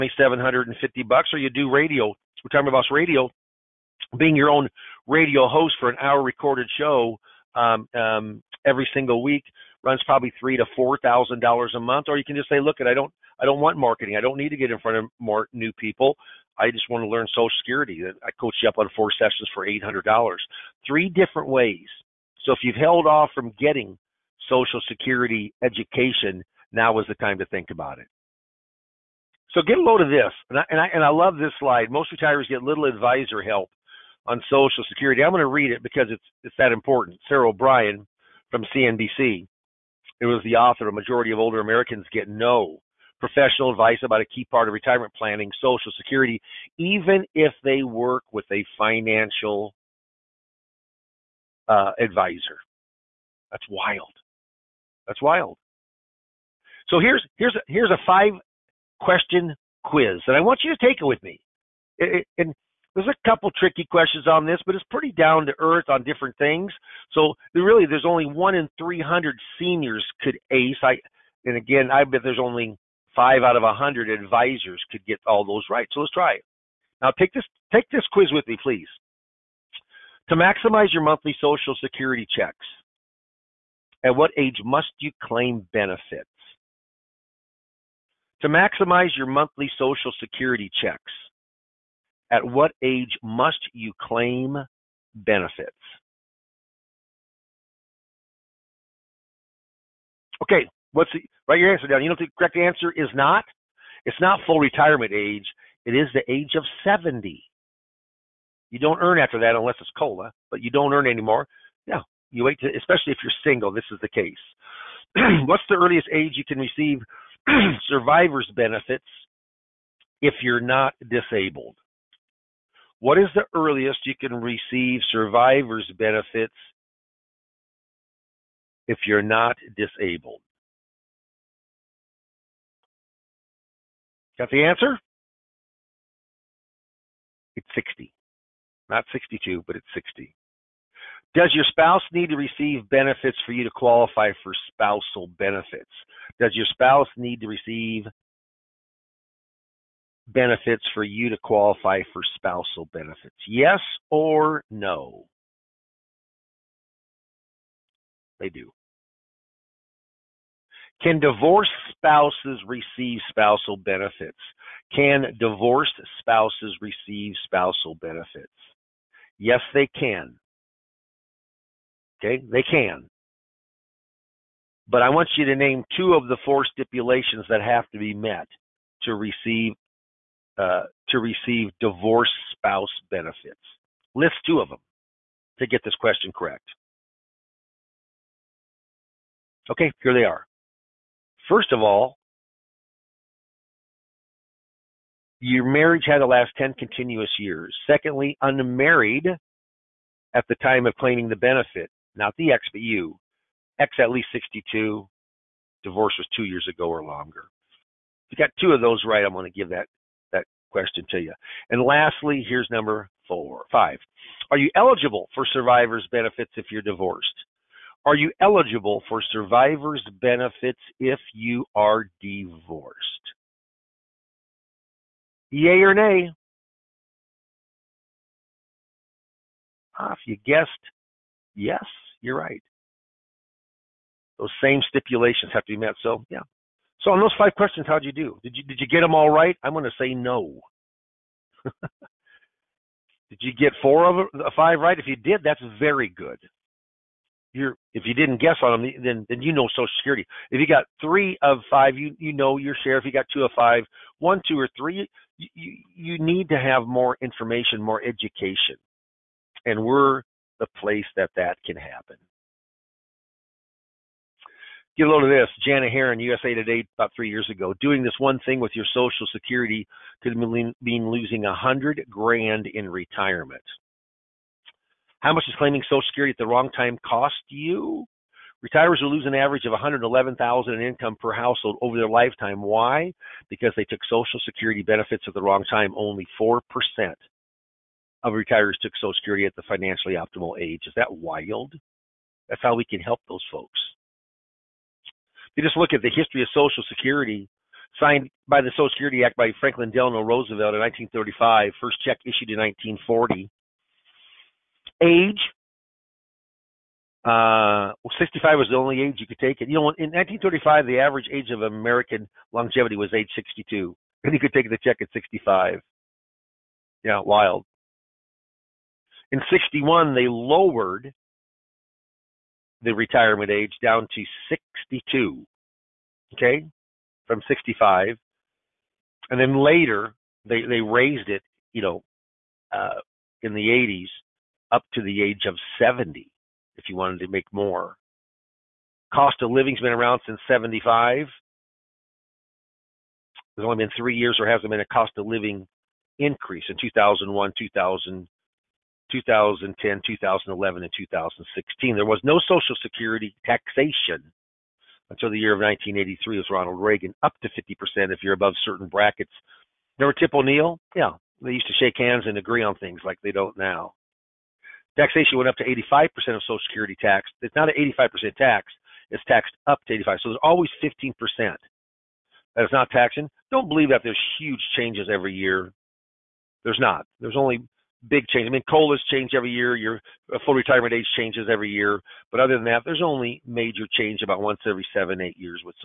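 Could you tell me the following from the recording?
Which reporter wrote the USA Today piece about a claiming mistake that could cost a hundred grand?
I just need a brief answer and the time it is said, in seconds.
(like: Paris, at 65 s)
Janet Heron, at 265 s.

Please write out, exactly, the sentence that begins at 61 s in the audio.
It, it, and there's a couple tricky questions on this, but it's pretty down to earth on different things.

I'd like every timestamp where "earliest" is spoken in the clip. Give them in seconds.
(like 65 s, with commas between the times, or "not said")
115 s, 123 s.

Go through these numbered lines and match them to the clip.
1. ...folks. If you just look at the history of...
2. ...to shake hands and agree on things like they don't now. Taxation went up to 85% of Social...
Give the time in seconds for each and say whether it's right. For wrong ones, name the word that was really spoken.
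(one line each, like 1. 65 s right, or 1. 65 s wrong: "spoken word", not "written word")
1. 293 s right
2. 361 s right.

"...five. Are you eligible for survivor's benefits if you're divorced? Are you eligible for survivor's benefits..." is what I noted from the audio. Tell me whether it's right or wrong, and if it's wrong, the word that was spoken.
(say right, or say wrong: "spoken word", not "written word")
right.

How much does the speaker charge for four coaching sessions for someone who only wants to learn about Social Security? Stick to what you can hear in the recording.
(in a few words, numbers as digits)
$800.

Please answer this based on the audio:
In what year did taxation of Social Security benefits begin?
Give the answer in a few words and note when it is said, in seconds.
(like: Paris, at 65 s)
1983, at 355 s.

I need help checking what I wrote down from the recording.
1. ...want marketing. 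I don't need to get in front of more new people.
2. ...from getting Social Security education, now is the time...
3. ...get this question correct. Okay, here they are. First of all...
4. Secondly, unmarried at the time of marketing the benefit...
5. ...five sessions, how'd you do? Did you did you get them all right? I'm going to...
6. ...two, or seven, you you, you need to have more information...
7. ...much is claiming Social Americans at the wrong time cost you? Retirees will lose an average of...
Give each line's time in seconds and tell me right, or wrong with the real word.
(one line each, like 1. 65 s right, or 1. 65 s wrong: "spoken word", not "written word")
1. 13 s right
2. 23 s right
3. 185 s right
4. 197 s wrong: "claiming", not "marketing"
5. 237 s wrong: "questions", not "sessions"
6. 254 s wrong: "three", not "seven"
7. 275 s wrong: "Security", not "Americans".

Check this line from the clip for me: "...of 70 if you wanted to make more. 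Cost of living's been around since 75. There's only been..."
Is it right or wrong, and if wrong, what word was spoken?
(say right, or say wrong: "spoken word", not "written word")
right.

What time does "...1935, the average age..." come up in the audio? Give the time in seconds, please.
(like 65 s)
310 s.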